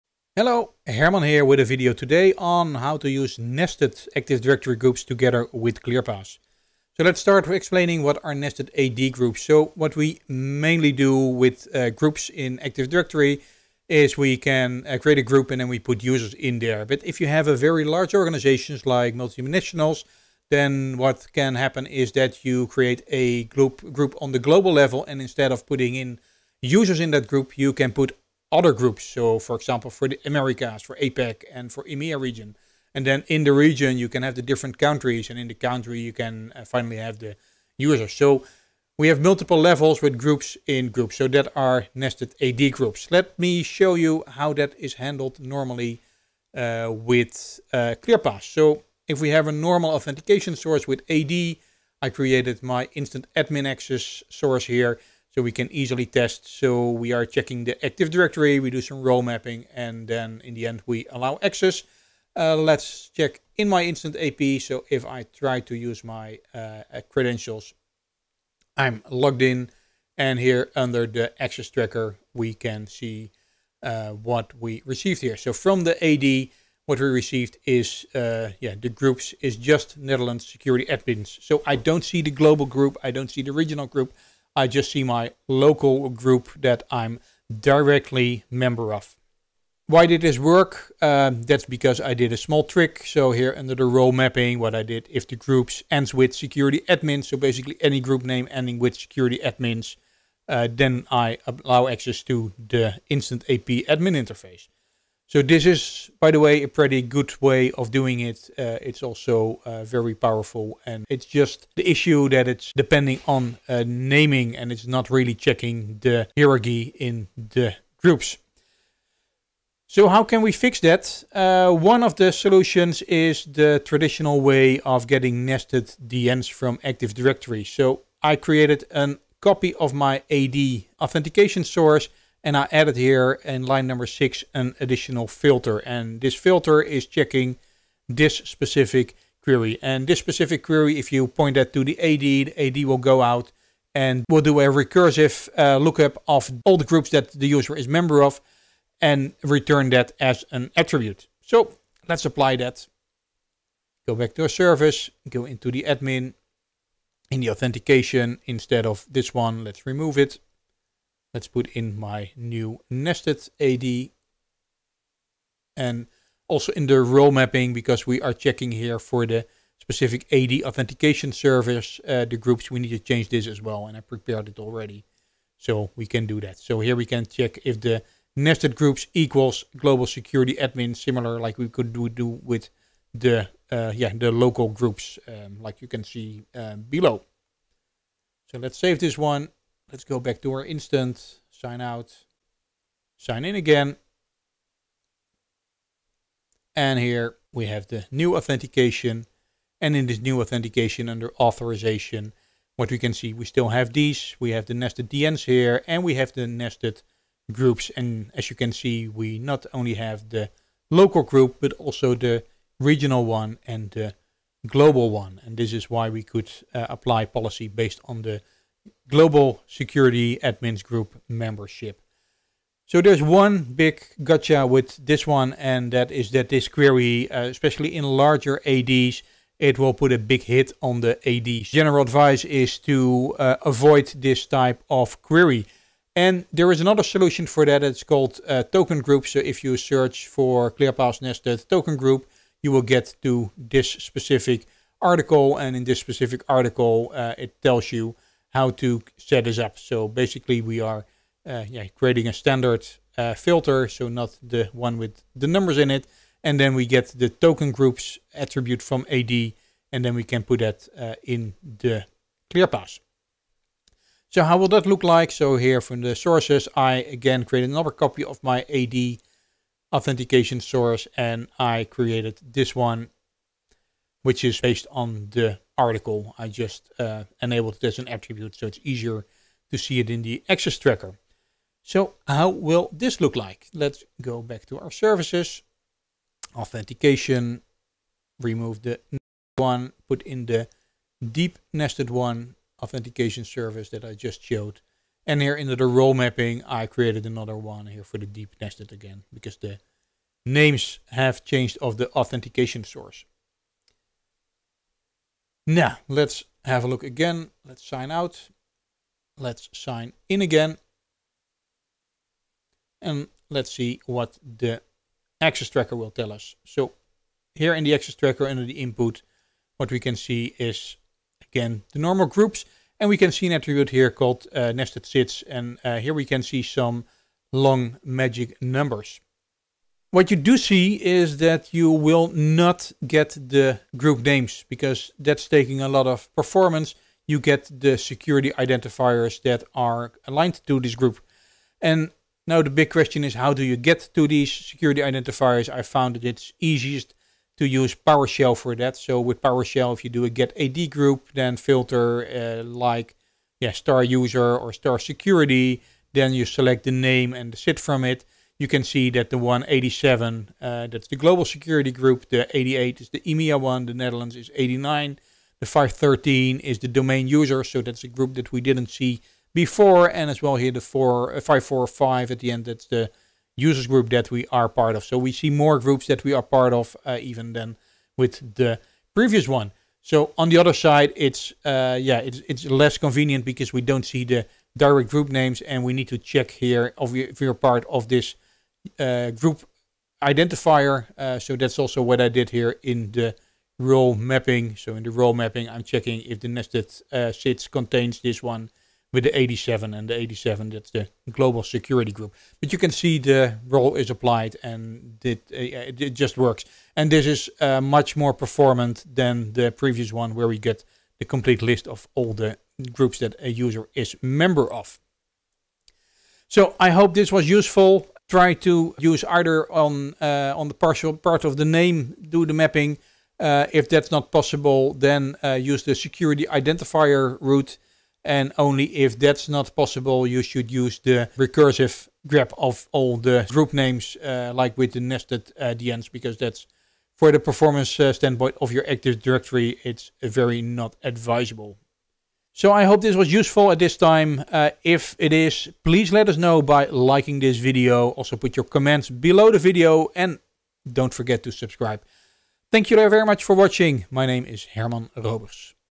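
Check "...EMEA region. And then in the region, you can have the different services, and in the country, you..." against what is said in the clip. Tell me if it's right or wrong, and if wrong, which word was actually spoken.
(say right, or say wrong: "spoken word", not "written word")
wrong: "countries", not "services".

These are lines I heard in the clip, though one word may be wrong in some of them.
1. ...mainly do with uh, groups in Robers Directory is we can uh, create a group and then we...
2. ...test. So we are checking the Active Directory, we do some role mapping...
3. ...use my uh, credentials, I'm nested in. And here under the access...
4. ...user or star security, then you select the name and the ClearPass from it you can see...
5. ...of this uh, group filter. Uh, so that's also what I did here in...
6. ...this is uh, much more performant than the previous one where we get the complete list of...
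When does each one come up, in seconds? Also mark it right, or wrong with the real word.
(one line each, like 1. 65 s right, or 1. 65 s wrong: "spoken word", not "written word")
1. 10 s wrong: "Active", not "Robers"
2. 56 s right
3. 65 s wrong: "logged", not "nested"
4. 354 s wrong: "SID", not "ClearPass"
5. 387 s wrong: "identifier", not "filter"
6. 407 s right.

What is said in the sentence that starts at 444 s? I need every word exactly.
Uh, if it is, please let us know by liking this video.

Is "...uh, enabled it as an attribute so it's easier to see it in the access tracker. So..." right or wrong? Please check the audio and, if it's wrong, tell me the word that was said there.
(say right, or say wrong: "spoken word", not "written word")
right.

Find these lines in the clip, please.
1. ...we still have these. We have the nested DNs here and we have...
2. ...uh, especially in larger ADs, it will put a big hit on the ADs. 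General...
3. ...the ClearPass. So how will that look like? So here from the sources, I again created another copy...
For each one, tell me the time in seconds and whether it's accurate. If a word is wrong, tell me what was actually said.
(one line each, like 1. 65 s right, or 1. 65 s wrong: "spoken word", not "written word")
1. 203 s right
2. 227 s right
3. 261 s right.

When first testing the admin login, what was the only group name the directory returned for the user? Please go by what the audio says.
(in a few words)
Netherlands security admins.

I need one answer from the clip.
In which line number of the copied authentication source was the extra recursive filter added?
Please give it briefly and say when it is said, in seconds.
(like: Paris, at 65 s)
6, at 133 s.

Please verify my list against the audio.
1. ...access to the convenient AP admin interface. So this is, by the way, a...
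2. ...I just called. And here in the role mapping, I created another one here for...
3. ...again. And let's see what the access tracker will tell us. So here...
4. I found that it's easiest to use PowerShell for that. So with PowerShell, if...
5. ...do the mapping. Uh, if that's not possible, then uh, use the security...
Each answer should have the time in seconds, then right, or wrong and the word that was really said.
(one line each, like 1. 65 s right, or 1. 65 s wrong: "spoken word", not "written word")
1. 101 s wrong: "instant", not "convenient"
2. 294 s wrong: "showed", not "called"
3. 310 s right
4. 345 s right
5. 422 s right.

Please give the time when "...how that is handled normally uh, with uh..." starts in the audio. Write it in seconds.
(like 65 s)
44 s.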